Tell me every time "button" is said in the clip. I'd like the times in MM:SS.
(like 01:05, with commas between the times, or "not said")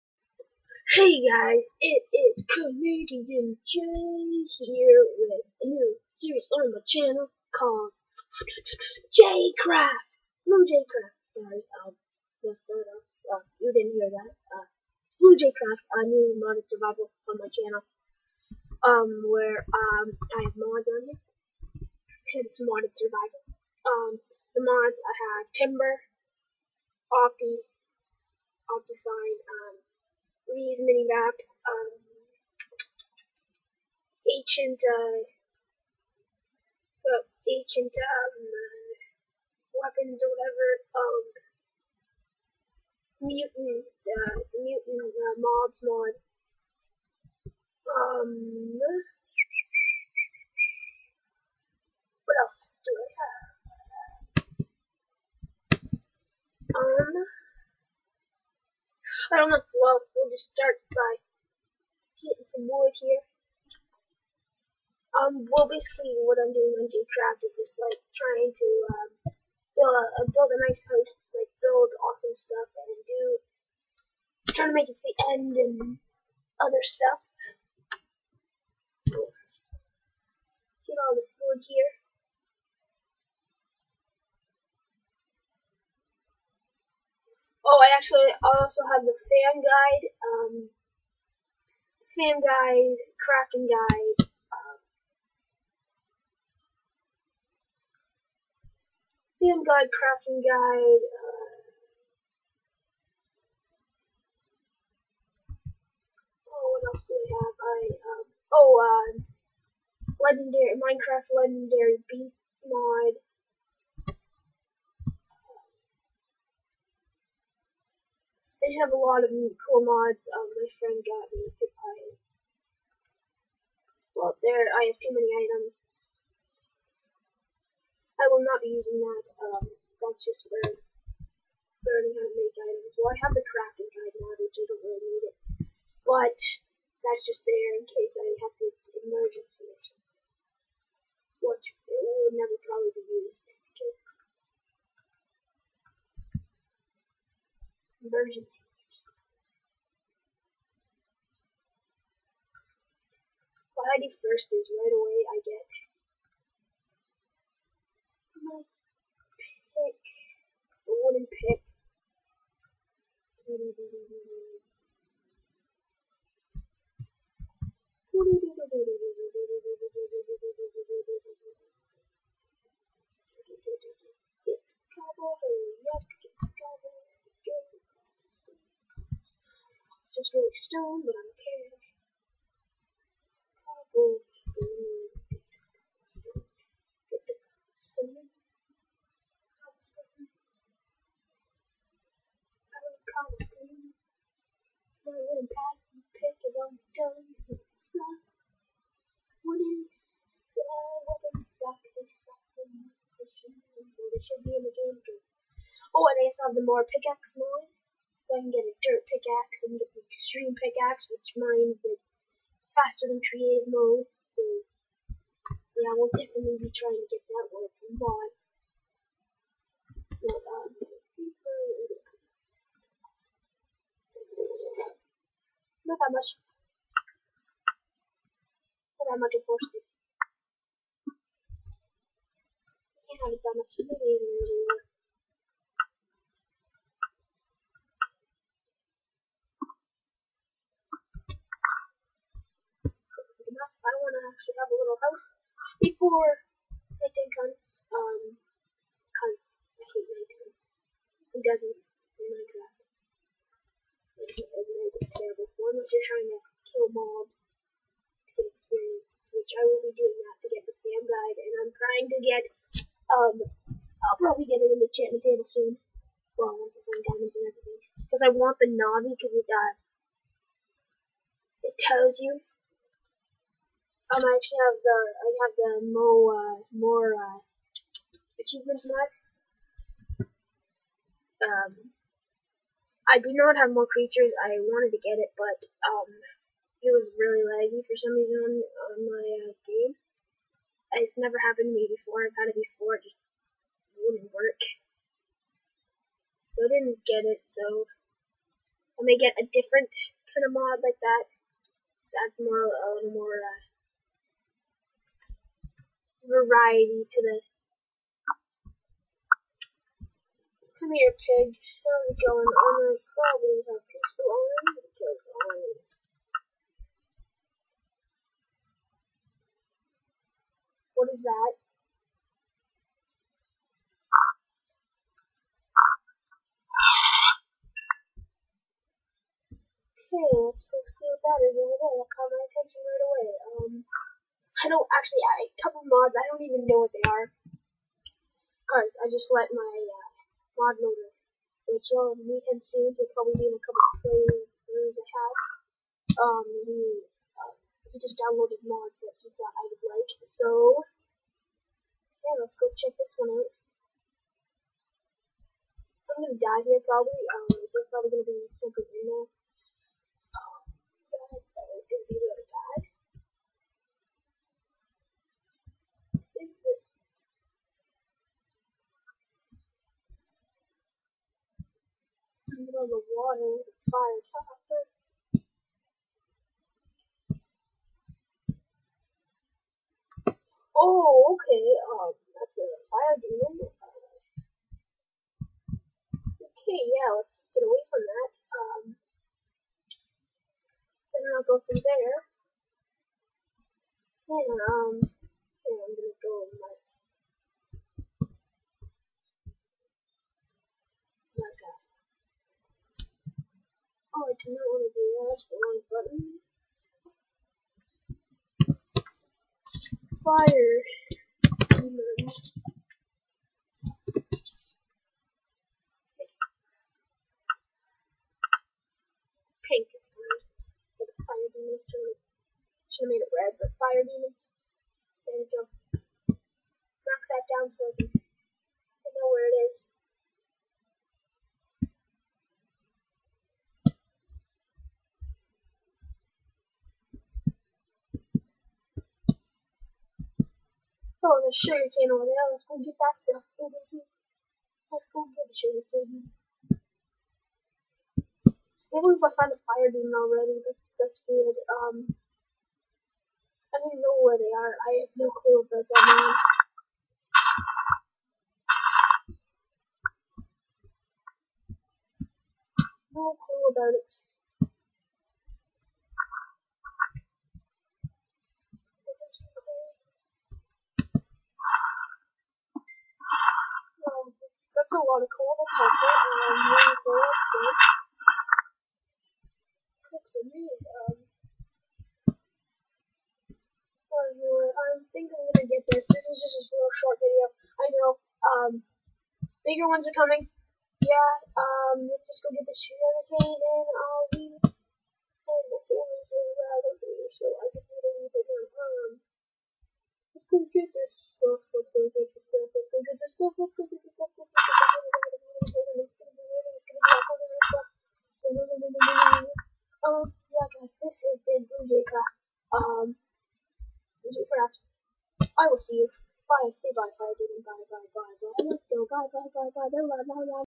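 06:45.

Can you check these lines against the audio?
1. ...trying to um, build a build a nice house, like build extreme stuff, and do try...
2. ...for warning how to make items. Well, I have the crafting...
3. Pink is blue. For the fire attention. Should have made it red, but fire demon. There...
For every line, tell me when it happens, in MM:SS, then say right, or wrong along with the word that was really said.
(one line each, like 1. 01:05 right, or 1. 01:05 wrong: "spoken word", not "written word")
1. 01:08 wrong: "awesome", not "extreme"
2. 02:10 wrong: "learning", not "warning"
3. 06:59 wrong: "demon", not "attention".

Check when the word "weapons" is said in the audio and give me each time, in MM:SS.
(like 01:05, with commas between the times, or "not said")
00:39, 03:21.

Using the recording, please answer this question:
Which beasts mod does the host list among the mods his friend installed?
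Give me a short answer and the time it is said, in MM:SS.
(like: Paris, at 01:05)
Minecraft Legendary Beasts, at 01:50.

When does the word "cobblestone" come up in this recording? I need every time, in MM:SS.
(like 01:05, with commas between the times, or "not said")
03:07, 03:13.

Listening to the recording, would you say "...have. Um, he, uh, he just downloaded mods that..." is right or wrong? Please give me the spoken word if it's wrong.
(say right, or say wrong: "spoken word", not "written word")
right.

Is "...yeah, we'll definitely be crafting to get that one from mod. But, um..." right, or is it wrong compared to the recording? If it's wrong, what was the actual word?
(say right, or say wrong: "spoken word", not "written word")
wrong: "trying", not "crafting".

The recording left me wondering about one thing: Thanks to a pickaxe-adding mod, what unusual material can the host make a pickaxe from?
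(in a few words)
dirt.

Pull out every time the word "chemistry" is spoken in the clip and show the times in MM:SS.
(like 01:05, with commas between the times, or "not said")
not said.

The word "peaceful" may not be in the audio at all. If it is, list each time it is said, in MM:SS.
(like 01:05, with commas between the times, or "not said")
05:13.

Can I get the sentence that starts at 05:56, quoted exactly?
I'm gonna die here probably, um, there's probably gonna be something in there.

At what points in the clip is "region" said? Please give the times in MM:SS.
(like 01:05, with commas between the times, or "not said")
not said.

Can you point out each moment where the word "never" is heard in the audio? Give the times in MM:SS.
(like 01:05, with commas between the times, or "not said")
02:22, 04:51.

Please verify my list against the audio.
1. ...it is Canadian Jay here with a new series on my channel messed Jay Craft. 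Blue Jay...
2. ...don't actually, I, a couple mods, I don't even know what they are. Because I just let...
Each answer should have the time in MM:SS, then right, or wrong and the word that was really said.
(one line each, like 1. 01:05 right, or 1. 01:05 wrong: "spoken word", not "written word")
1. 00:01 wrong: "called", not "messed"
2. 05:34 right.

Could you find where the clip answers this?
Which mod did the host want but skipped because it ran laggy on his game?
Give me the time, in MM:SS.
04:43.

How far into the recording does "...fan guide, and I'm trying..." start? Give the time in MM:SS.
04:20.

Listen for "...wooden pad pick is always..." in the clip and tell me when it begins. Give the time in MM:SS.
03:15.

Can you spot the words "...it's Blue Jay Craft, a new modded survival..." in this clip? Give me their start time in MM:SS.
00:15.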